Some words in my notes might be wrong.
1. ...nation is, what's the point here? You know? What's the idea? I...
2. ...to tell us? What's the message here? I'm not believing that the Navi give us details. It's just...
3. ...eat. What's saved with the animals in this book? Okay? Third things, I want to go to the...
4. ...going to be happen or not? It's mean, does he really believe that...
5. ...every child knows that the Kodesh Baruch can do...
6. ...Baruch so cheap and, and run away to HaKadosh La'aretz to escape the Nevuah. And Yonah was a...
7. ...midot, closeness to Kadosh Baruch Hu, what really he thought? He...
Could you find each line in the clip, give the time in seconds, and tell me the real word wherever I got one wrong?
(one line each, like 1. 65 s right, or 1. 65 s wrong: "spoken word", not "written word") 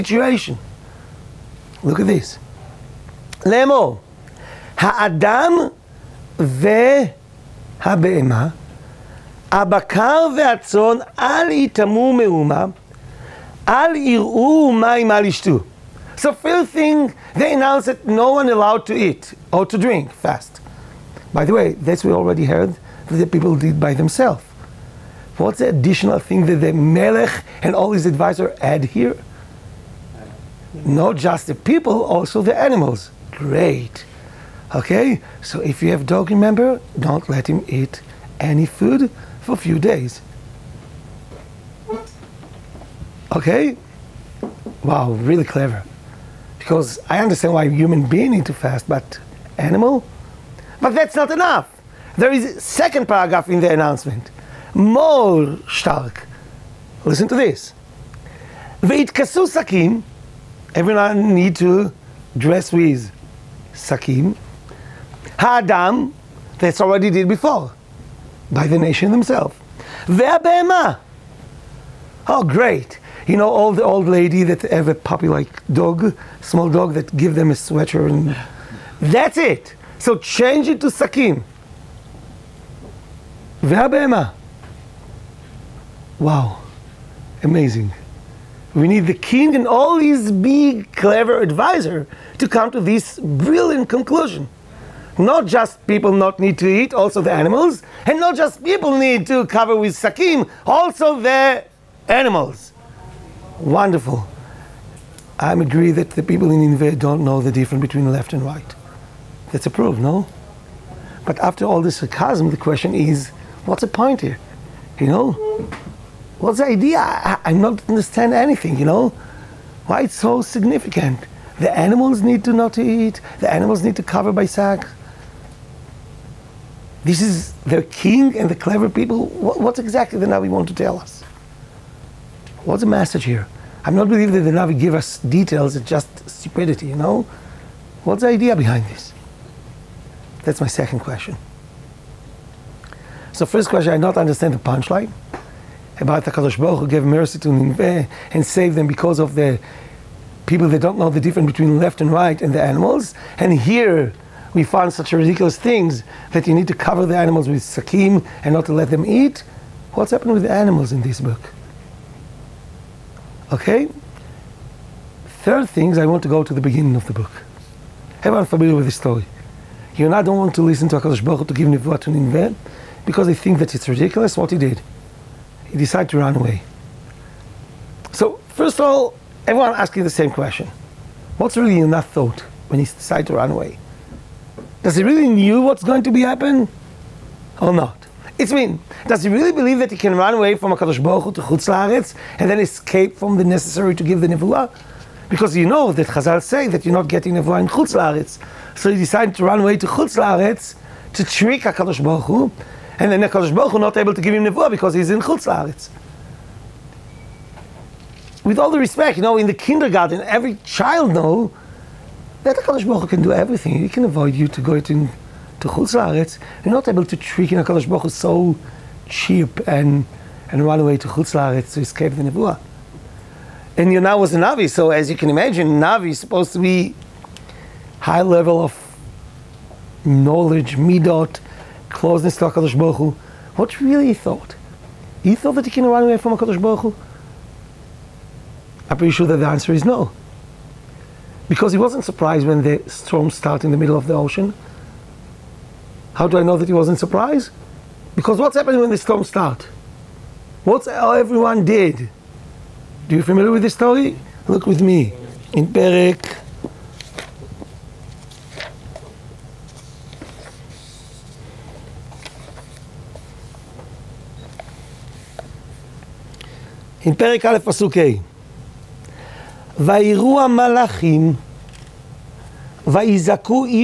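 1. 112 s wrong: "question", not "nation"
2. 130 s right
3. 159 s wrong: "happened", not "saved"
4. 185 s right
5. 210 s right
6. 217 s wrong: "Chutz", not "HaKadosh"
7. 230 s wrong: "HaKadosh", not "Kadosh".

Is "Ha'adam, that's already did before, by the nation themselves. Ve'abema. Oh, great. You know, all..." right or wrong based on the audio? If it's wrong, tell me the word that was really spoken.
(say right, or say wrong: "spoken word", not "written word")
right.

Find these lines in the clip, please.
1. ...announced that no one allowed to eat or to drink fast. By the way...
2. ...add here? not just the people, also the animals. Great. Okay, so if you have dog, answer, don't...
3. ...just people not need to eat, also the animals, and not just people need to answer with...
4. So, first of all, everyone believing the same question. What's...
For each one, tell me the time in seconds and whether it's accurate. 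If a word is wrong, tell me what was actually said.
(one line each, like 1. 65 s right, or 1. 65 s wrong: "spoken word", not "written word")
1. 17 s right
2. 28 s wrong: "remember", not "answer"
3. 95 s wrong: "cover", not "answer"
4. 178 s wrong: "asking", not "believing".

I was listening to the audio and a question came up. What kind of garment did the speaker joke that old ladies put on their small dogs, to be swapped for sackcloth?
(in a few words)
a sweater.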